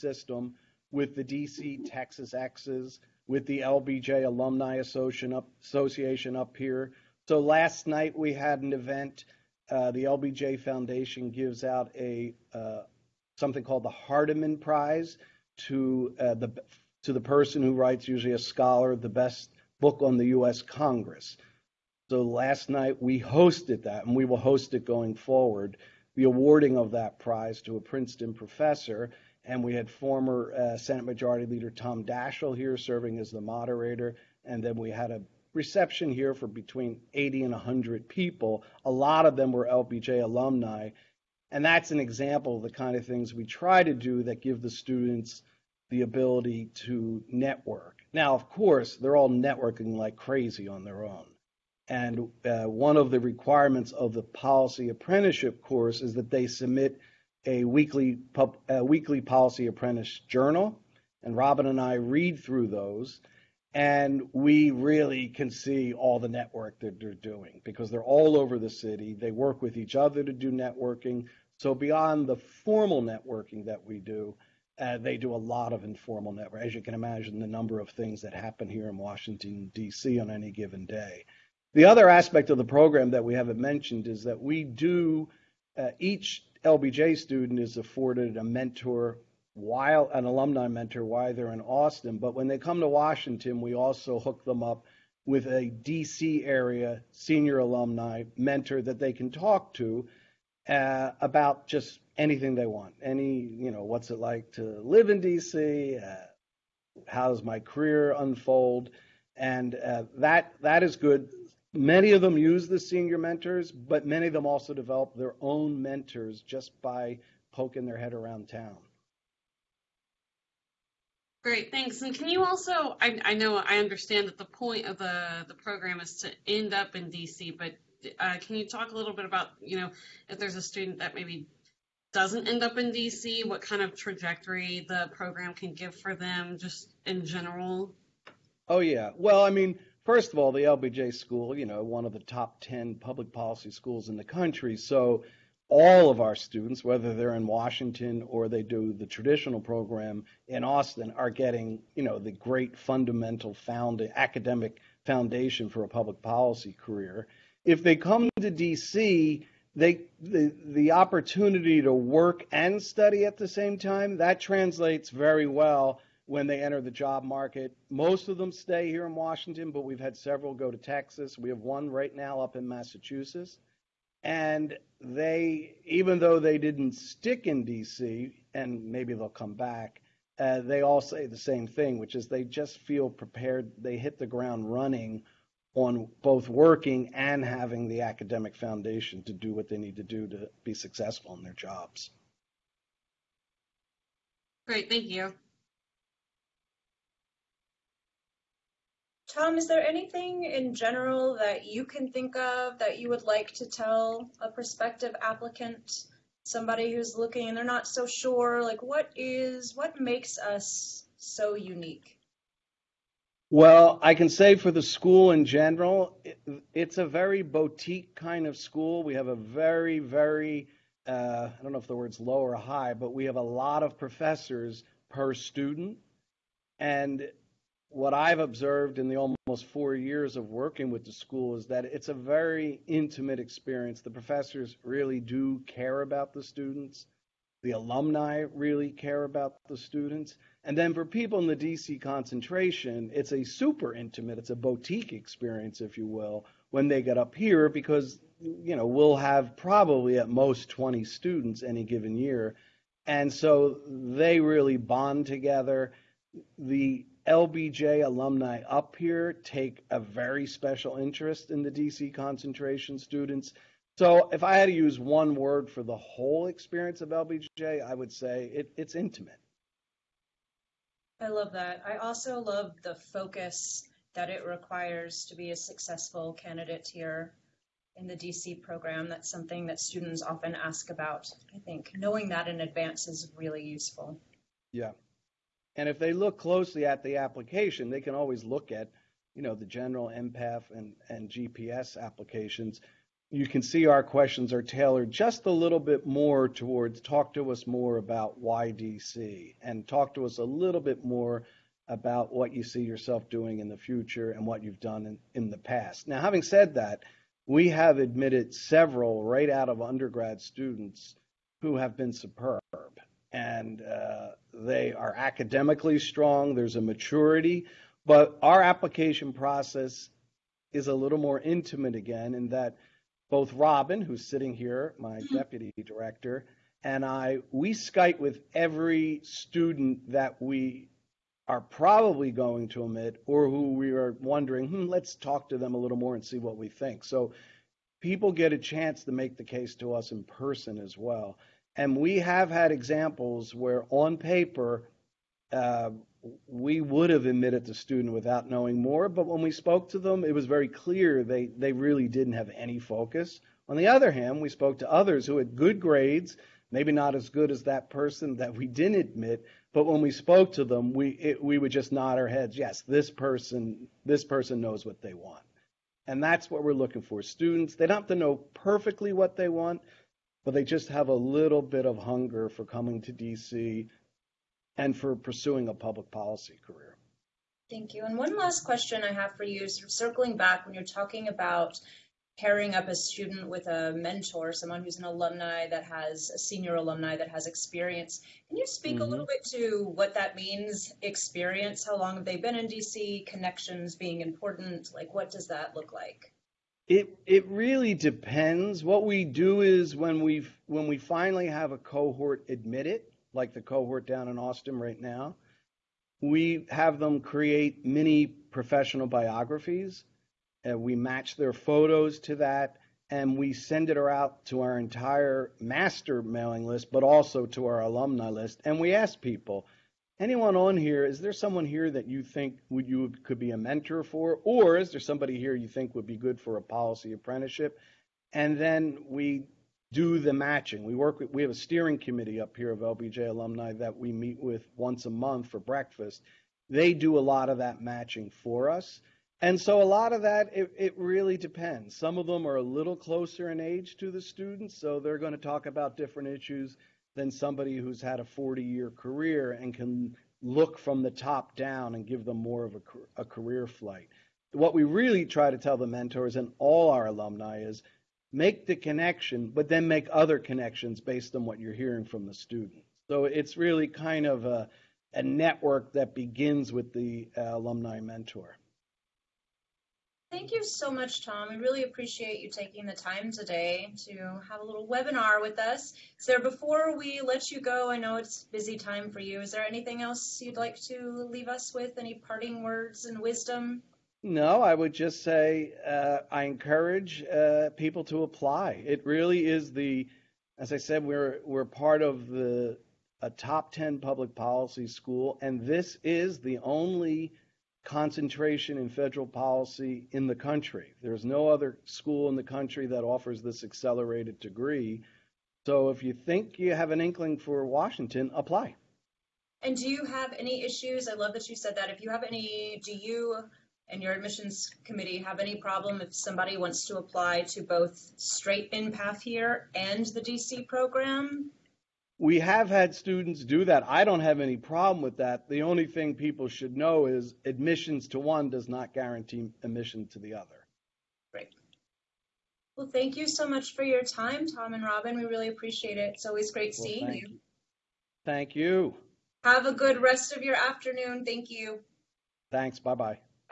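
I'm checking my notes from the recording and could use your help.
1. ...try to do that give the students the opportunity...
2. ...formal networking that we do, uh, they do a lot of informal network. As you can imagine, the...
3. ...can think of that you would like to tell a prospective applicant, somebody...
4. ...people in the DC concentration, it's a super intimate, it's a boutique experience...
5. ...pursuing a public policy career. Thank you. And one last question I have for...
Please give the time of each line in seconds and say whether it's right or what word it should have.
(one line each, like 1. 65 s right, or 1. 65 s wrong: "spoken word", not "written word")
1. 43 s wrong: "ability", not "opportunity"
2. 72 s right
3. 201 s right
4. 241 s right
5. 375 s right.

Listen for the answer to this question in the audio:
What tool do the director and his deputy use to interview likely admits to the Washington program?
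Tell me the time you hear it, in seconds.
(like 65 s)
327 s.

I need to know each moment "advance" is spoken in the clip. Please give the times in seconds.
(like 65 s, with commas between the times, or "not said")
282 s.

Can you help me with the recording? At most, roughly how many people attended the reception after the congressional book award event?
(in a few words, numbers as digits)
100.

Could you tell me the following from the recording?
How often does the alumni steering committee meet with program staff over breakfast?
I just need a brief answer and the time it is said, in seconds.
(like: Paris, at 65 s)
once a month, at 434 s.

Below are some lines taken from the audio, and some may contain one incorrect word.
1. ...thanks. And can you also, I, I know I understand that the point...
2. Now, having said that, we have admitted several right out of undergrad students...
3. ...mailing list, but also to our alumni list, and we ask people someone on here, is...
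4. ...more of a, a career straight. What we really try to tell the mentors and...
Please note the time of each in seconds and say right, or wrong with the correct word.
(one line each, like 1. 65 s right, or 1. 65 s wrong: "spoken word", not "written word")
1. 121 s right
2. 306 s right
3. 416 s wrong: "anyone", not "someone"
4. 452 s wrong: "flight", not "straight".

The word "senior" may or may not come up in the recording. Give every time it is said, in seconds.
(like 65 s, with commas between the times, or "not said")
97 s, 112 s, 386 s.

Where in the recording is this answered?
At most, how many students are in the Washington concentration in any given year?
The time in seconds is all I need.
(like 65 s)
250 s.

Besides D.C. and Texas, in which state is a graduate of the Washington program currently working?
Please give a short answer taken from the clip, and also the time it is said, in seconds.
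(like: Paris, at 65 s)
Massachusetts, at 172 s.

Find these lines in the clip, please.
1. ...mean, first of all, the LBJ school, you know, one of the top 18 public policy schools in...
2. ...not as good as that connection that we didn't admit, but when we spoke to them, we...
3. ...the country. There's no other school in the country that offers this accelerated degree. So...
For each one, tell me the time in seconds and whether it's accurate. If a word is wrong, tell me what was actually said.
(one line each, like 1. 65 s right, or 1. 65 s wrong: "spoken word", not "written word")
1. 139 s wrong: "10", not "18"
2. 356 s wrong: "person", not "connection"
3. 500 s right.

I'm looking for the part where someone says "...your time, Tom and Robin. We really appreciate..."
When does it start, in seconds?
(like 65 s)
533 s.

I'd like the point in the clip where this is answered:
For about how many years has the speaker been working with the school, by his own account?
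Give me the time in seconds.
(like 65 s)
229 s.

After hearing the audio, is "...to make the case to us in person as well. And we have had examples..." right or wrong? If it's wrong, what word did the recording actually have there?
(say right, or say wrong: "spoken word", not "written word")
right.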